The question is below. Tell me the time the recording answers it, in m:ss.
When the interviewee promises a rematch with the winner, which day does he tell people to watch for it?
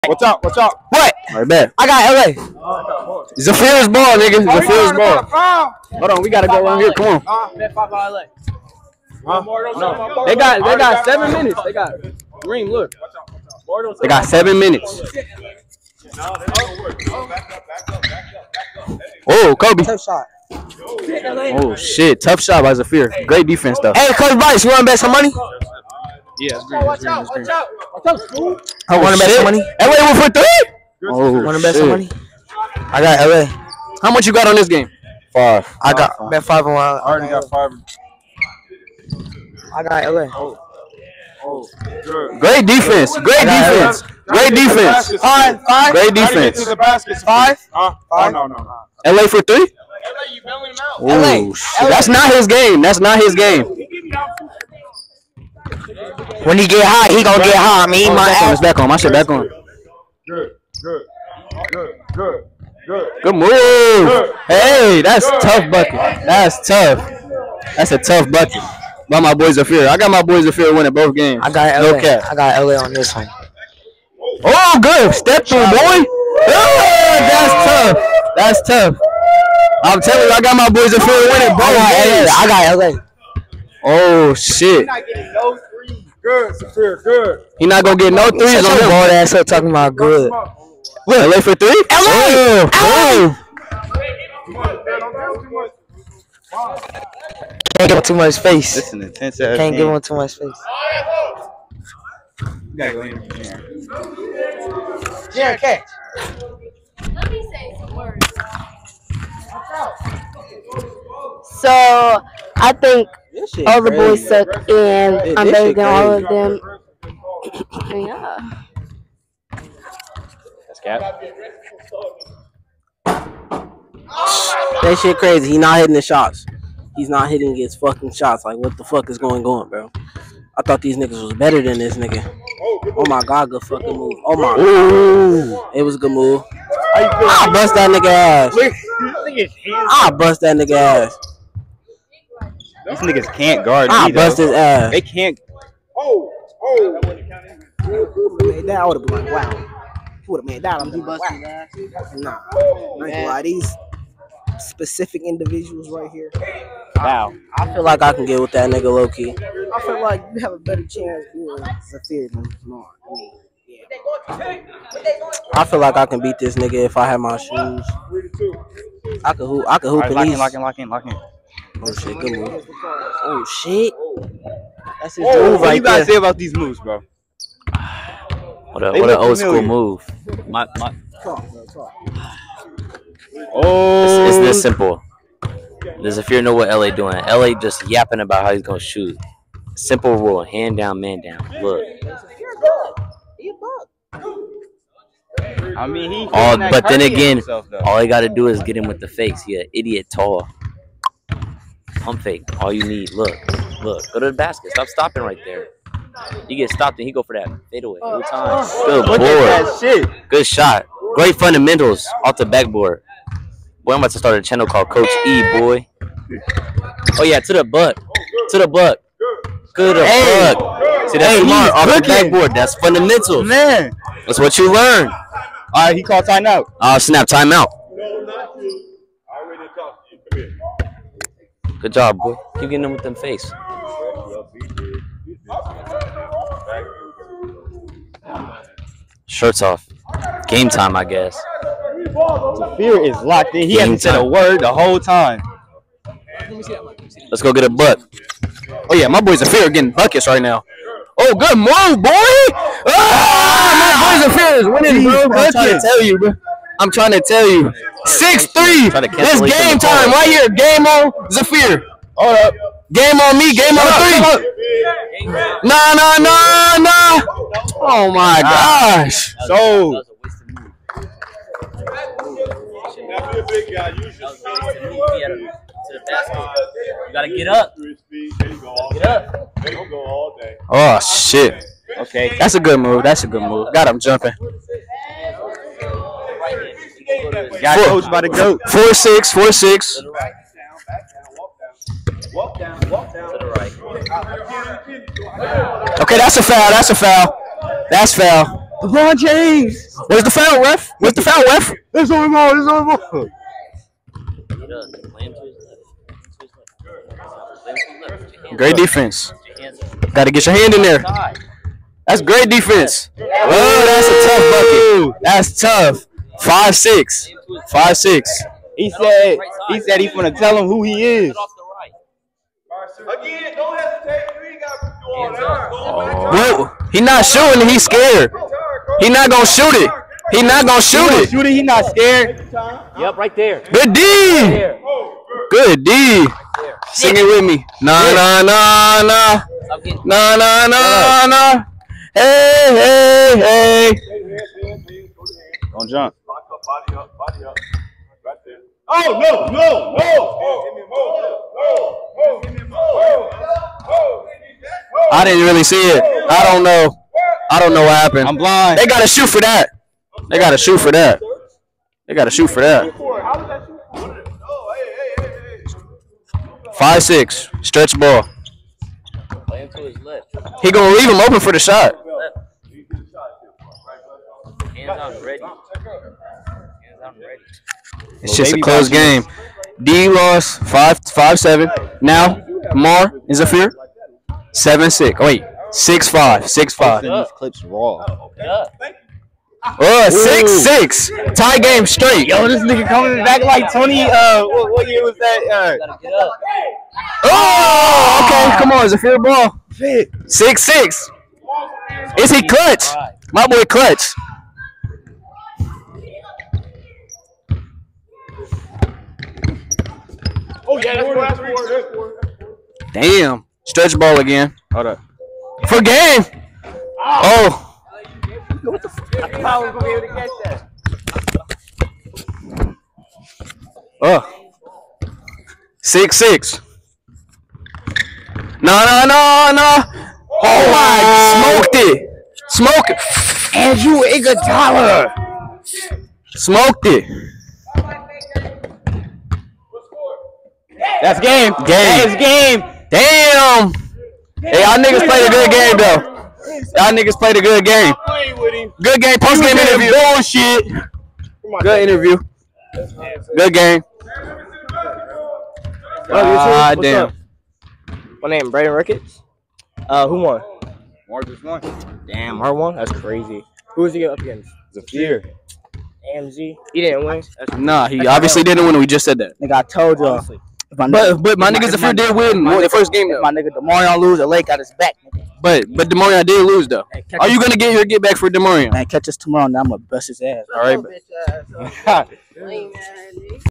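7:59.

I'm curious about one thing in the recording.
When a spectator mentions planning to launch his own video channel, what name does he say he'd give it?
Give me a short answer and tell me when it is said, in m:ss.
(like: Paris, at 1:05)
Coach E, at 3:34.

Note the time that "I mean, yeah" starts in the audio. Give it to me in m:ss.
2:43.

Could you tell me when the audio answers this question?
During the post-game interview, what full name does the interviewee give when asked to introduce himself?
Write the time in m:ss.
7:38.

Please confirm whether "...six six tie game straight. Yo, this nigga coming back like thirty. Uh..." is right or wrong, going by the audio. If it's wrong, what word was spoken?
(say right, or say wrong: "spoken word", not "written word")
wrong: "twenty", not "thirty".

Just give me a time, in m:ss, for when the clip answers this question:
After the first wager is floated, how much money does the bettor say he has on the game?
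0:35.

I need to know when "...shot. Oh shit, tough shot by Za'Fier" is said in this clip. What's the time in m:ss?
0:20.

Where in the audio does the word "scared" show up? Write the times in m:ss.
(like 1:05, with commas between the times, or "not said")
5:27, 5:31.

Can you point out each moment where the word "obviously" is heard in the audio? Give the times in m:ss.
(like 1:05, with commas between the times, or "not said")
7:48.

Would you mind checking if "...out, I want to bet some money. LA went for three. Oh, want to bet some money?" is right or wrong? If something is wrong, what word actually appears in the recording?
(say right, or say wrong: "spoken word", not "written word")
right.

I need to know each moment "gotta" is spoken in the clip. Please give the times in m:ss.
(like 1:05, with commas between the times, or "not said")
0:06, 1:42, 2:55, 4:37.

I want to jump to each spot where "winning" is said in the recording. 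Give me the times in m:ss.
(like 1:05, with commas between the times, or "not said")
1:10, 1:21, 4:14.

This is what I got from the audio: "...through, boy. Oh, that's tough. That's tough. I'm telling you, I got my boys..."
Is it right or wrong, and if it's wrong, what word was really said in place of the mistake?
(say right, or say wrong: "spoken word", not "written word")
right.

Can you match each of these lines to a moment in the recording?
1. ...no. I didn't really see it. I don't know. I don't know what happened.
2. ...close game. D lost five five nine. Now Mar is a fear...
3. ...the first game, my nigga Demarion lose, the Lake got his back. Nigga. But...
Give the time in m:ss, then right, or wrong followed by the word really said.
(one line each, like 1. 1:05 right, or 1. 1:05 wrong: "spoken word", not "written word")
1. 5:52 right
2. 6:18 wrong: "seven", not "nine"
3. 7:52 right.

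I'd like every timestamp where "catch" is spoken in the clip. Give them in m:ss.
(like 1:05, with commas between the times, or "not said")
1:45, 7:00, 7:58.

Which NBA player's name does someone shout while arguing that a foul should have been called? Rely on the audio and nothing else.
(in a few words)
LeBron James.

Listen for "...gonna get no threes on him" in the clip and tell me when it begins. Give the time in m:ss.
1:27.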